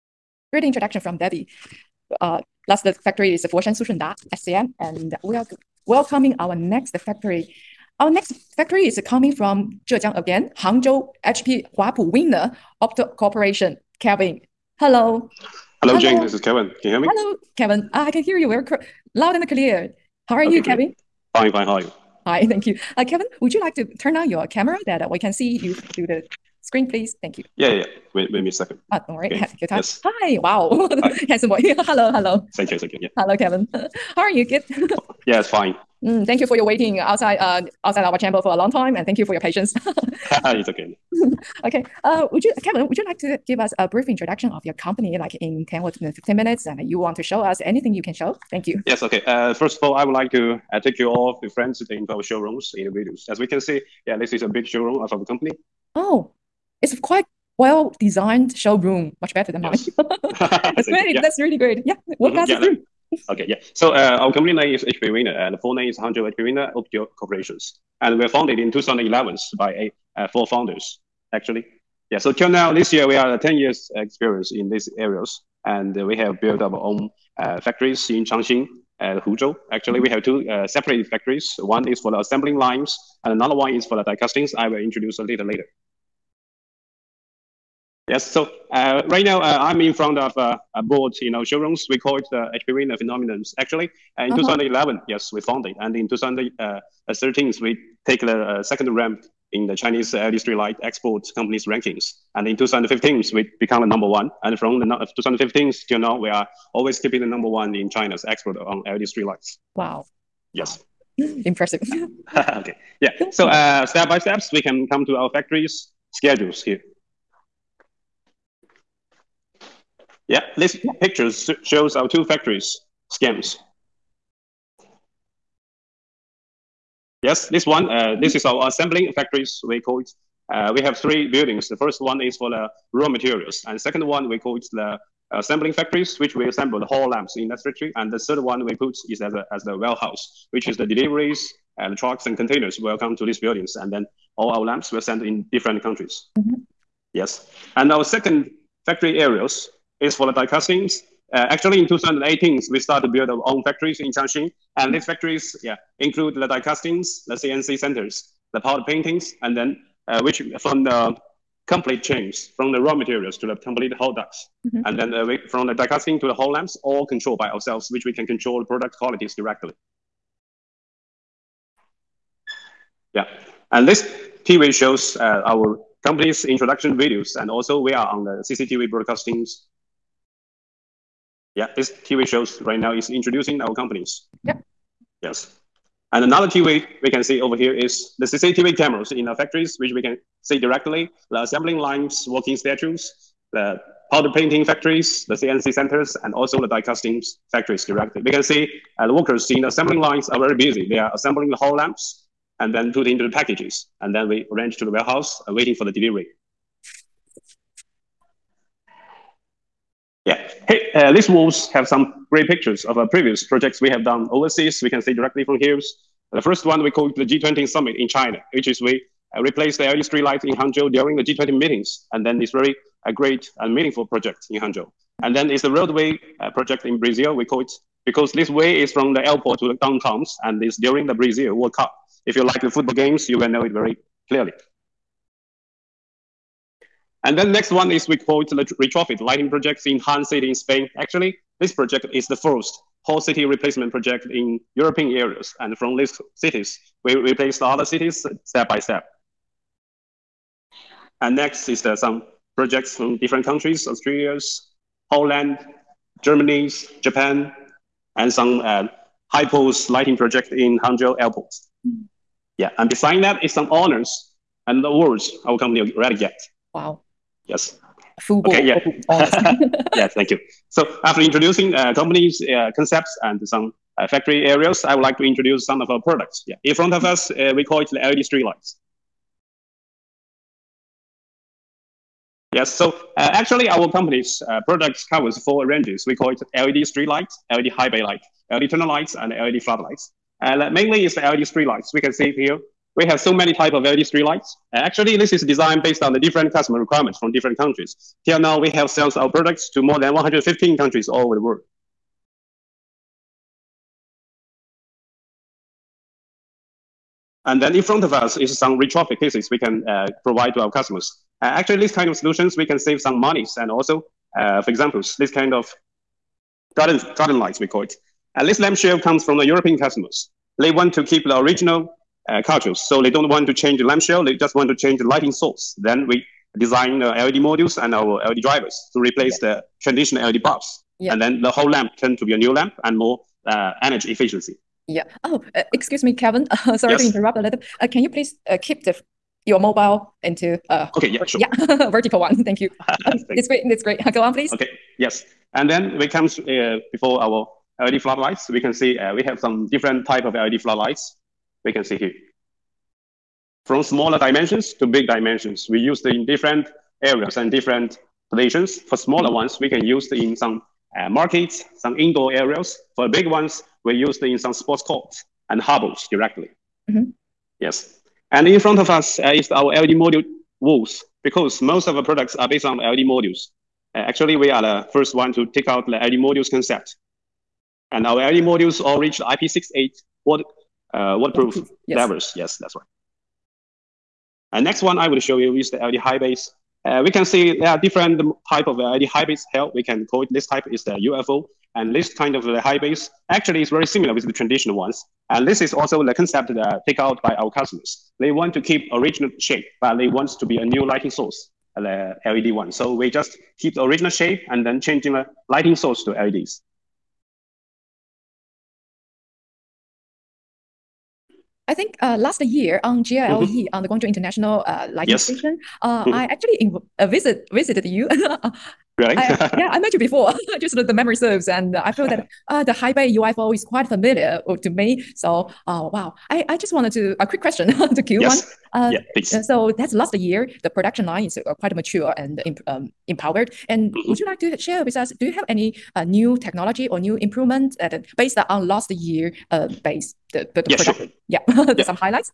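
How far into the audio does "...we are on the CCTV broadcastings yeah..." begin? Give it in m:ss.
2:57.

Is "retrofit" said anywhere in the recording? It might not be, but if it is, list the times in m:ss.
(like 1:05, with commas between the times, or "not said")
3:58, 5:08.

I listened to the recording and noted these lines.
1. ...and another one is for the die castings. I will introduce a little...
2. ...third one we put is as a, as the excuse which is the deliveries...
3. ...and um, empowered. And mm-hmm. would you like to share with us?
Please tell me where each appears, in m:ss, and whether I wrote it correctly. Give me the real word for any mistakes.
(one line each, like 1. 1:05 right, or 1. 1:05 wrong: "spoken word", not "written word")
1. 1:23 right
2. 2:18 wrong: "warehouse", not "excuse"
3. 7:12 right.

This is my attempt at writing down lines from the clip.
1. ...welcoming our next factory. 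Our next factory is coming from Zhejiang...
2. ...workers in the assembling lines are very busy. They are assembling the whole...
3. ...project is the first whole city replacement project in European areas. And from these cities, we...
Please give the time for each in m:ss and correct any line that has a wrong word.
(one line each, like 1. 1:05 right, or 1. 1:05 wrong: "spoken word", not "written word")
1. 0:05 right
2. 3:19 right
3. 4:01 right.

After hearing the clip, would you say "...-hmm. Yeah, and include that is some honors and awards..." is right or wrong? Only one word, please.
wrong.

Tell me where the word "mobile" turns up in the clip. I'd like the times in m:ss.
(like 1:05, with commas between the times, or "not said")
5:39.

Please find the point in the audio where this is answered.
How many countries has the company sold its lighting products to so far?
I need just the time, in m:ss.
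4:59.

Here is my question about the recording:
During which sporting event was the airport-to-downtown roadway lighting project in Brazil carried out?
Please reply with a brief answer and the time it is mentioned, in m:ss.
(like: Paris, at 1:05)
Brazil World Cup, at 3:51.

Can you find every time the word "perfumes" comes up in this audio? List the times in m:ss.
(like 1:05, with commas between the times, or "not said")
not said.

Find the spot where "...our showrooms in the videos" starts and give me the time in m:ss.
0:52.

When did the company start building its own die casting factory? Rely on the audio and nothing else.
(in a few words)
2018.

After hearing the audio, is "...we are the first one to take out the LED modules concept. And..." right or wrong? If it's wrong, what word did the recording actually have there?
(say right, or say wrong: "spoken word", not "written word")
right.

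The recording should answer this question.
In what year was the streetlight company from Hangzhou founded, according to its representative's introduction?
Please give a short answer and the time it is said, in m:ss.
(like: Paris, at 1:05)
2011, at 1:08.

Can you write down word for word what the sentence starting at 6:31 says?
And this kind of the uh, hybrids actually is very similar with the traditional ones.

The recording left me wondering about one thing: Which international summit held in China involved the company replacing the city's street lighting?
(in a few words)
G20 Summit.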